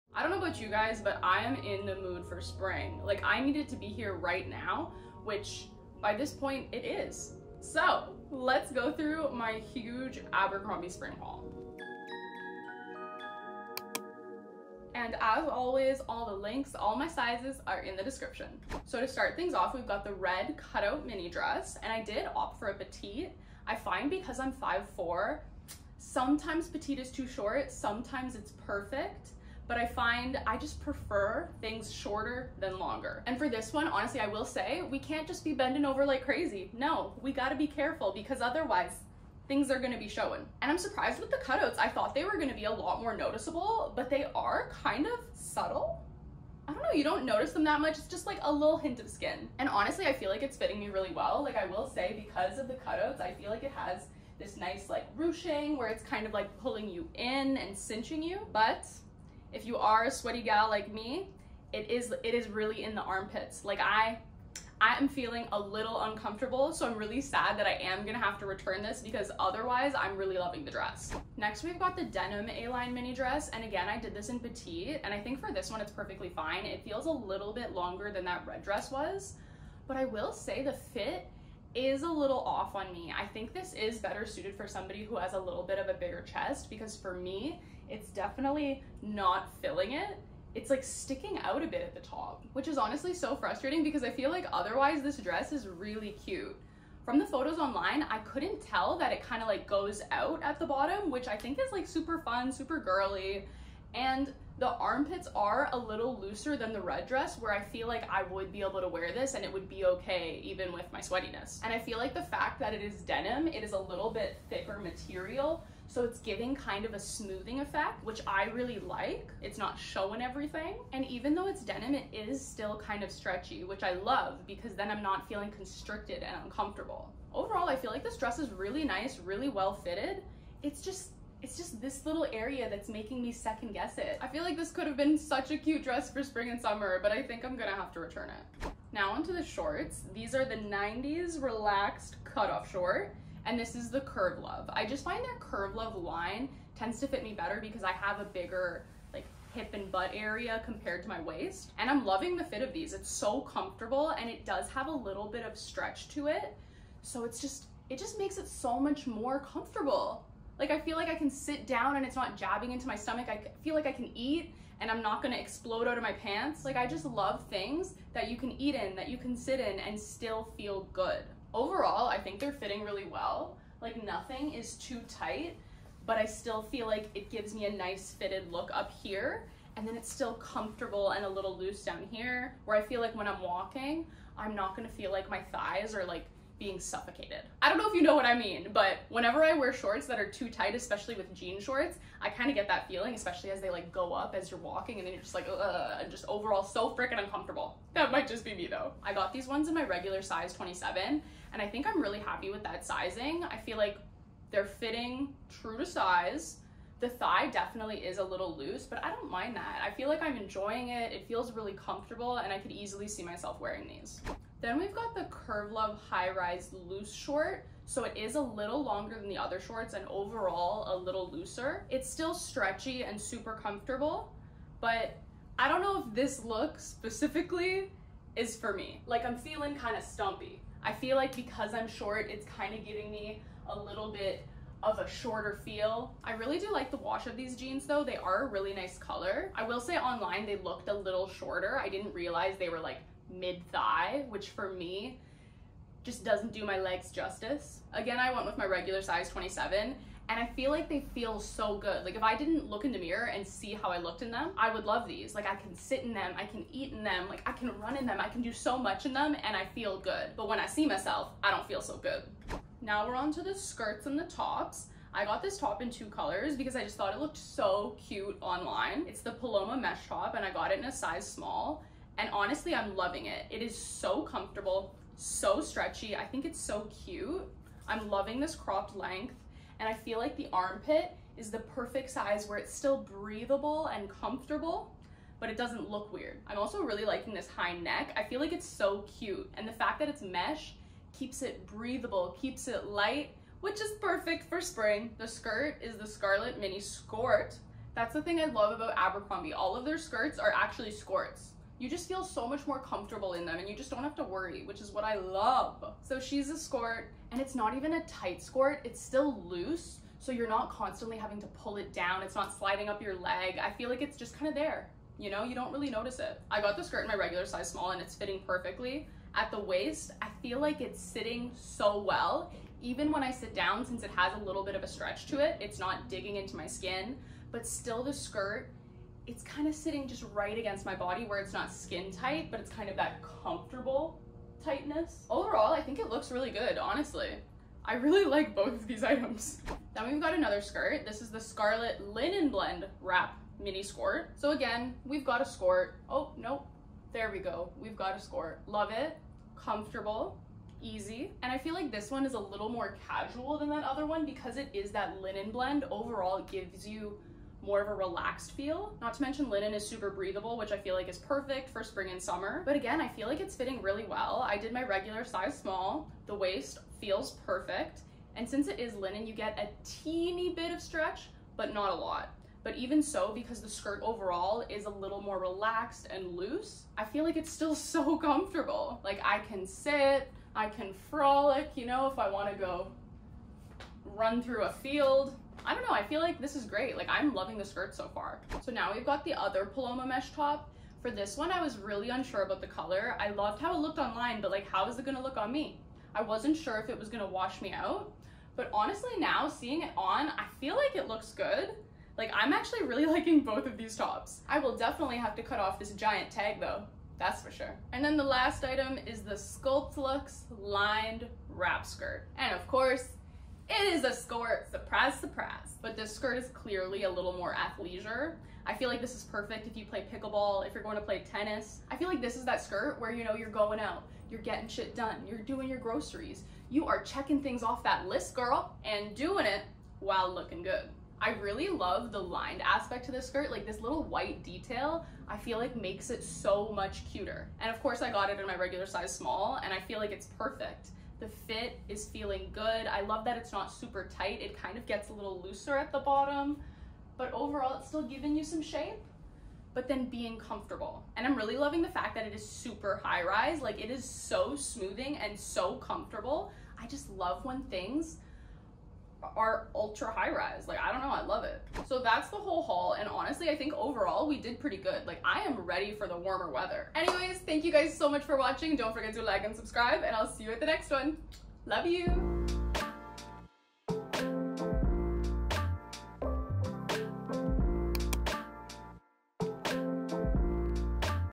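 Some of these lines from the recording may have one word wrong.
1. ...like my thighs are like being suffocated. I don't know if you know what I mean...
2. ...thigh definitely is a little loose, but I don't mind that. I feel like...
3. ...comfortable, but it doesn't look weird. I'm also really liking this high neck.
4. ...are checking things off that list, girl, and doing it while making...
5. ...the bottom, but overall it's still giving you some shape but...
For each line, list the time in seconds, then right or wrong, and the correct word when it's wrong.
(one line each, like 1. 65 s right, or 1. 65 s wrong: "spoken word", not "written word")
1. 185 s right
2. 207 s right
3. 284 s right
4. 426 s wrong: "looking", not "making"
5. 445 s right.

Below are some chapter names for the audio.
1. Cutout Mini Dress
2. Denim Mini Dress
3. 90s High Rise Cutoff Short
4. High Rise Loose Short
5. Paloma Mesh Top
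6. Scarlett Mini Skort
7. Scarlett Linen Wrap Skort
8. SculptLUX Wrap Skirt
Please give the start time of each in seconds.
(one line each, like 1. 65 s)
1. 19 s
2. 71 s
3. 138 s
4. 214 s
5. 262 s
6. 295 s
7. 339 s
8. 407 s.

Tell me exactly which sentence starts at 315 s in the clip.
You know, you don't really notice it.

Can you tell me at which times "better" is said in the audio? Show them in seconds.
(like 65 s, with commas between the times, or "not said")
83 s, 147 s.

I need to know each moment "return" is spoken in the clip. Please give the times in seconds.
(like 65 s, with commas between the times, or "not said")
68 s, 137 s.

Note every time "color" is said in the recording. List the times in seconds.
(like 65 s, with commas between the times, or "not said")
238 s, 266 s, 392 s.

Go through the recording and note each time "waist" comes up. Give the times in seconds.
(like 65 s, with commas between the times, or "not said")
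151 s, 319 s, 366 s.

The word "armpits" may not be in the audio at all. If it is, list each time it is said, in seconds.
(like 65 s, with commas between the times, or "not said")
63 s, 104 s, 280 s.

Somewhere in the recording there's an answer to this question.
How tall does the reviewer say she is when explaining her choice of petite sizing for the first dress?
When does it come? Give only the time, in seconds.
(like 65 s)
24 s.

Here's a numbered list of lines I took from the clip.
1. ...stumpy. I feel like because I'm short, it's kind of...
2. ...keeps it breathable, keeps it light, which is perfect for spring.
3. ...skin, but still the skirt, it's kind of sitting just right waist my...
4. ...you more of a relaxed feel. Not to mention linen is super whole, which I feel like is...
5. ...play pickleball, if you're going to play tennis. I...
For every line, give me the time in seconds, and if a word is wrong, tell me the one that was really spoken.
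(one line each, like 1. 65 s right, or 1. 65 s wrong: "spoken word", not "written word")
1. 230 s right
2. 291 s right
3. 326 s wrong: "against", not "waist"
4. 356 s wrong: "breathable", not "whole"
5. 419 s right.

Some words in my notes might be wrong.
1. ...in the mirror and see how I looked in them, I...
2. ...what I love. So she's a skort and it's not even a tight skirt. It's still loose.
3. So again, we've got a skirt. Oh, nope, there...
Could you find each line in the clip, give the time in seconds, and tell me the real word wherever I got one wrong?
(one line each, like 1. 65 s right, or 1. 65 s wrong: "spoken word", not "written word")
1. 252 s right
2. 304 s right
3. 344 s right.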